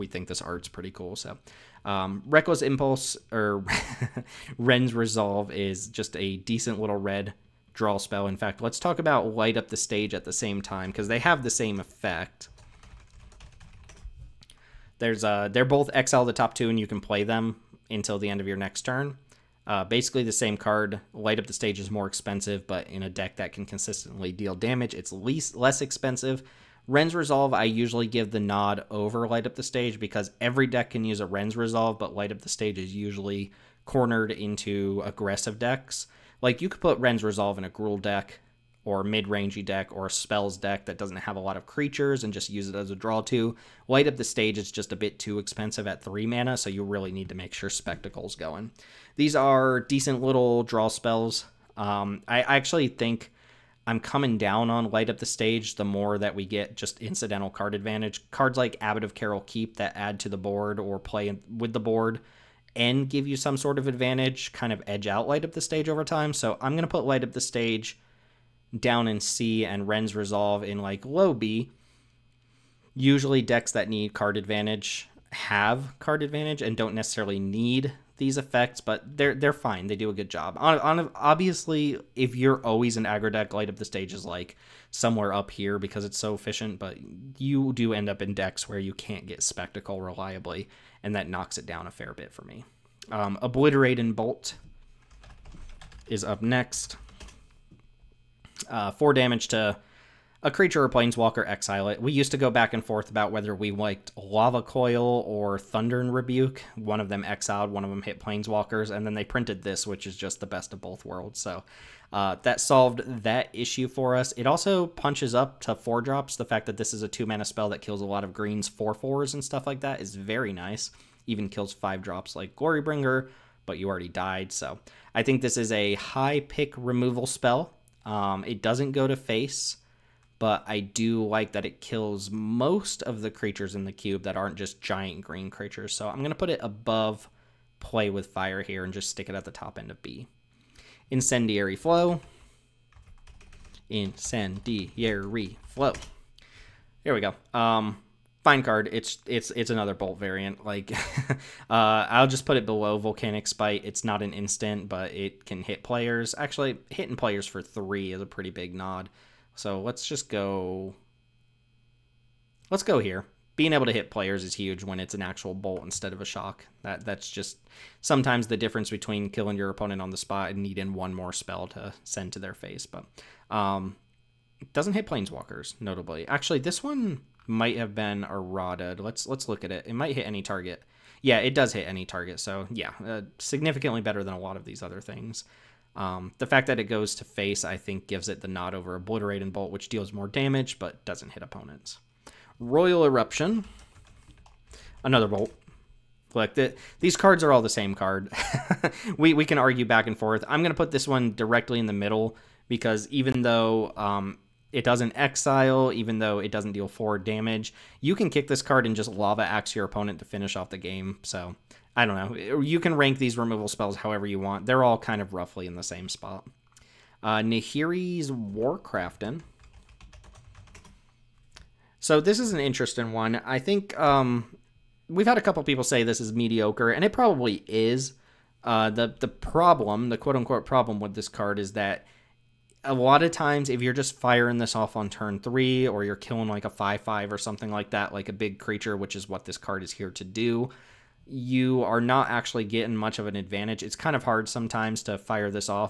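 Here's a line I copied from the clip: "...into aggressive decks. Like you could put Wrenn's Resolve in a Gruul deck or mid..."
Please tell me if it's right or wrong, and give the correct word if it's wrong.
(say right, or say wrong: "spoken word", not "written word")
right.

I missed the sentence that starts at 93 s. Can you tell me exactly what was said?
Um, Obliterating Bolt is up next.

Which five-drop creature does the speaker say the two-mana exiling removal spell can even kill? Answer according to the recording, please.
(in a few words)
Glorybringer.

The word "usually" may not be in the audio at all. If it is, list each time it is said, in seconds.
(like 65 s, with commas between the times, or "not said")
27 s, 32 s, 72 s.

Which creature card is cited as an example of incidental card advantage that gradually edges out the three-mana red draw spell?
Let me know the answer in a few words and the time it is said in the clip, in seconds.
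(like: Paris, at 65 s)
Abbot of Keral Keep, at 58 s.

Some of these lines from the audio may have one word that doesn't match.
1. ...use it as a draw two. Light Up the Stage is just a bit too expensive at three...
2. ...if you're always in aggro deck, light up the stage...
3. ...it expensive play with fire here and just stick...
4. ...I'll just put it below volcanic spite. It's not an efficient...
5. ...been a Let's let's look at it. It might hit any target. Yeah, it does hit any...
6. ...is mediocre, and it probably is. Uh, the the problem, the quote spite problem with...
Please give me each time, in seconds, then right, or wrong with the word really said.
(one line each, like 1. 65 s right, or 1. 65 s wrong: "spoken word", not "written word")
1. 42 s right
2. 82 s right
3. 136 s wrong: "above", not "expensive"
4. 152 s wrong: "instant", not "efficient"
5. 177 s right
6. 226 s wrong: "unquote", not "spite".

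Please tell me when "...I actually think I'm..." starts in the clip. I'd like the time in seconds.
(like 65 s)
52 s.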